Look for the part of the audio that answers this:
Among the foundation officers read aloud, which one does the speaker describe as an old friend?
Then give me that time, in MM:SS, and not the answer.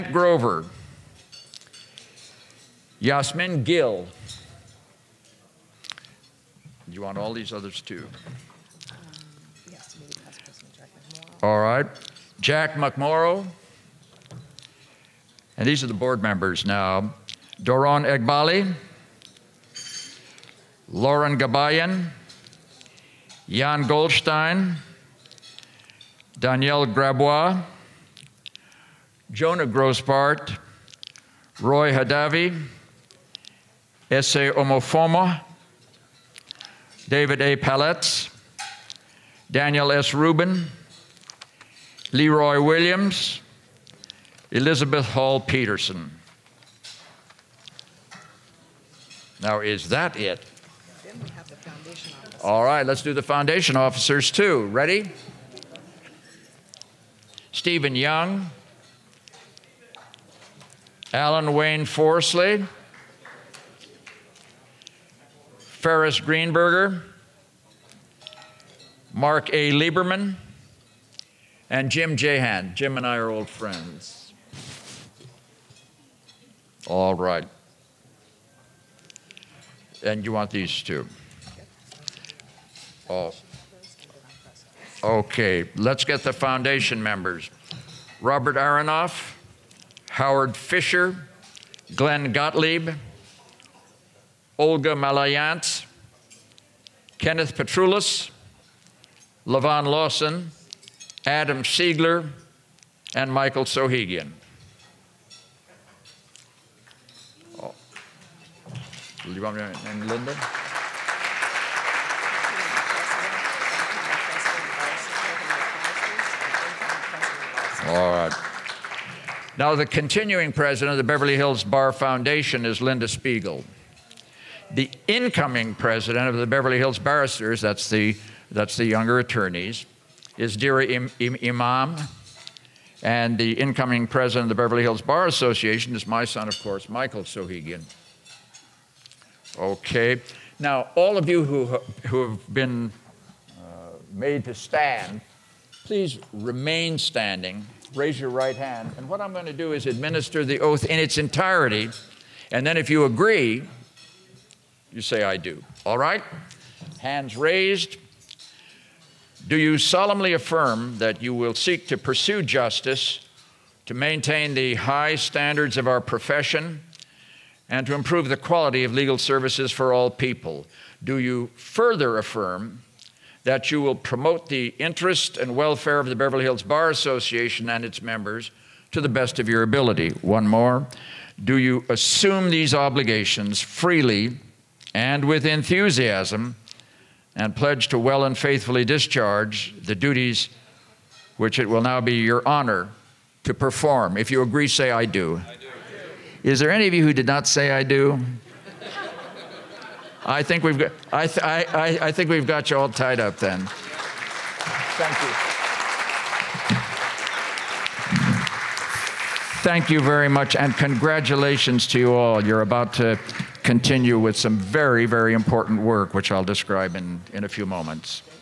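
01:11.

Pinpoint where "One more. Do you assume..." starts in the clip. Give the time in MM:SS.
03:00.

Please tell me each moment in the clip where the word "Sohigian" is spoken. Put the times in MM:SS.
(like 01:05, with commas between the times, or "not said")
01:43, 02:17.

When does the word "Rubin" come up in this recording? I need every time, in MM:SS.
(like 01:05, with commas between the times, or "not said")
00:40.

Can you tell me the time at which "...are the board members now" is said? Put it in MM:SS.
00:15.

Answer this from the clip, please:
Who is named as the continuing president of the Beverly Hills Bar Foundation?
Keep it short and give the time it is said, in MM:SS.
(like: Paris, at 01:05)
Linda Spiegel, at 02:02.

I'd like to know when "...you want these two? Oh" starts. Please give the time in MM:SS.
01:20.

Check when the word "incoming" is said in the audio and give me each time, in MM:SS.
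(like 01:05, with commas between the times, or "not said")
02:05, 02:13.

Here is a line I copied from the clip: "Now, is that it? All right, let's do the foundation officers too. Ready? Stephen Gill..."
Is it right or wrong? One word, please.
wrong.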